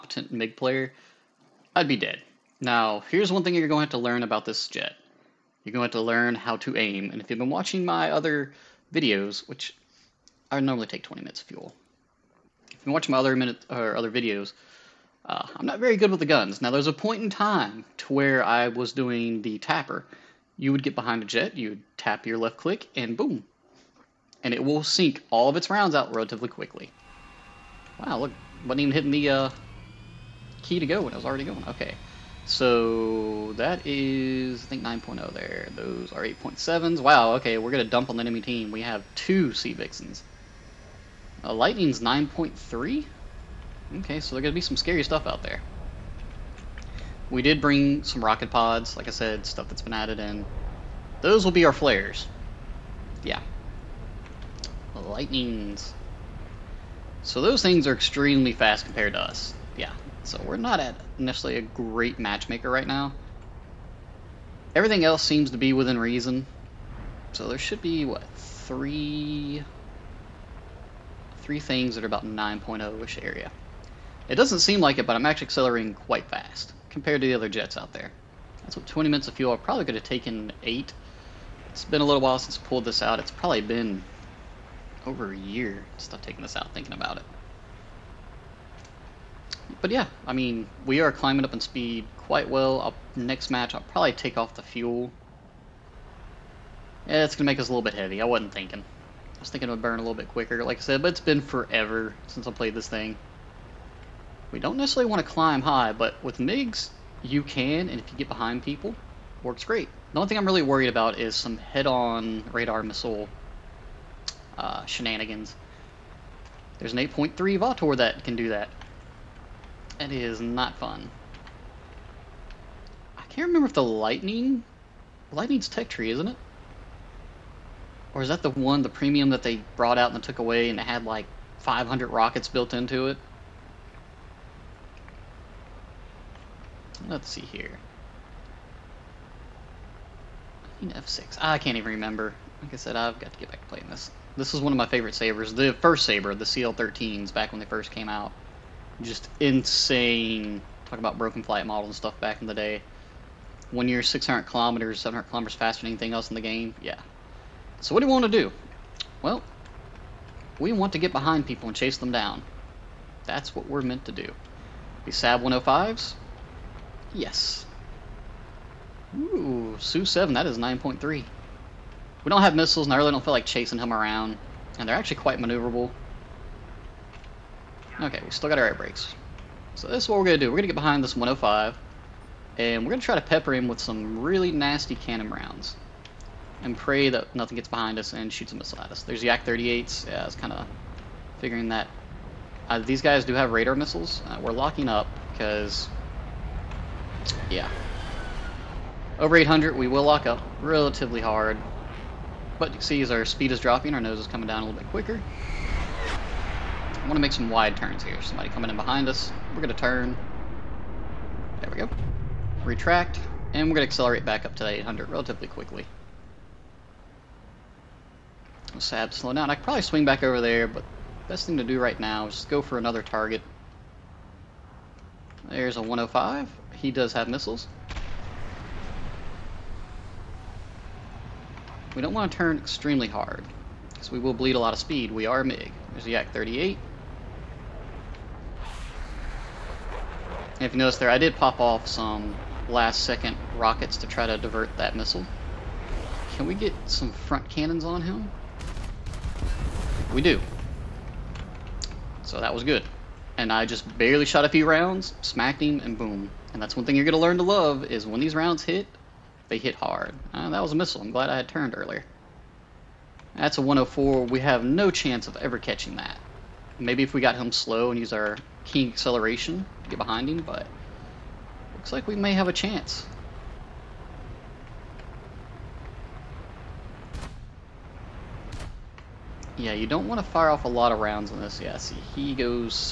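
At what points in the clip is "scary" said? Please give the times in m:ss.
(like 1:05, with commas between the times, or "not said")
0:44.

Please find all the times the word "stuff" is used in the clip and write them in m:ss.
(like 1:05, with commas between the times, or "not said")
0:45, 0:49, 2:31.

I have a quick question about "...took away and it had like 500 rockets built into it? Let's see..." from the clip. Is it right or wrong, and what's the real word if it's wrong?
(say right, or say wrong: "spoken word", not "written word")
right.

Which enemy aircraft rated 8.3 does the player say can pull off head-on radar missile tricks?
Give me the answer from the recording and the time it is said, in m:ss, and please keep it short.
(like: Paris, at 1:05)
Vautour, at 1:57.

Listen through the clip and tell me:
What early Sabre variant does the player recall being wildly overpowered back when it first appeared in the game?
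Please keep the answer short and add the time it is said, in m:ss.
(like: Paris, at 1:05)
CL-13, at 2:26.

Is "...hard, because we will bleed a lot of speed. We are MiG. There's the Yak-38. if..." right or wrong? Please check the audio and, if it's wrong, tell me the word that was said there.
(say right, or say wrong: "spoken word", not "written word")
right.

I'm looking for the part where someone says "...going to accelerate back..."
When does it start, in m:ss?
3:33.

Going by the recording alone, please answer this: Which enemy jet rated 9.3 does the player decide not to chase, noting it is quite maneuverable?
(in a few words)
Su-7.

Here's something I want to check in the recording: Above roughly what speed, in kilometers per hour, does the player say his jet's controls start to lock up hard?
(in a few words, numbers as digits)
800.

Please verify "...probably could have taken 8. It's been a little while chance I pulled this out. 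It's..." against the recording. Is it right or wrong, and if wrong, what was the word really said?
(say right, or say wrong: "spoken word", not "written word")
wrong: "since", not "chance".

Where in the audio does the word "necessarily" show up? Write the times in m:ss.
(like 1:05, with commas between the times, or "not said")
1:01, 1:44.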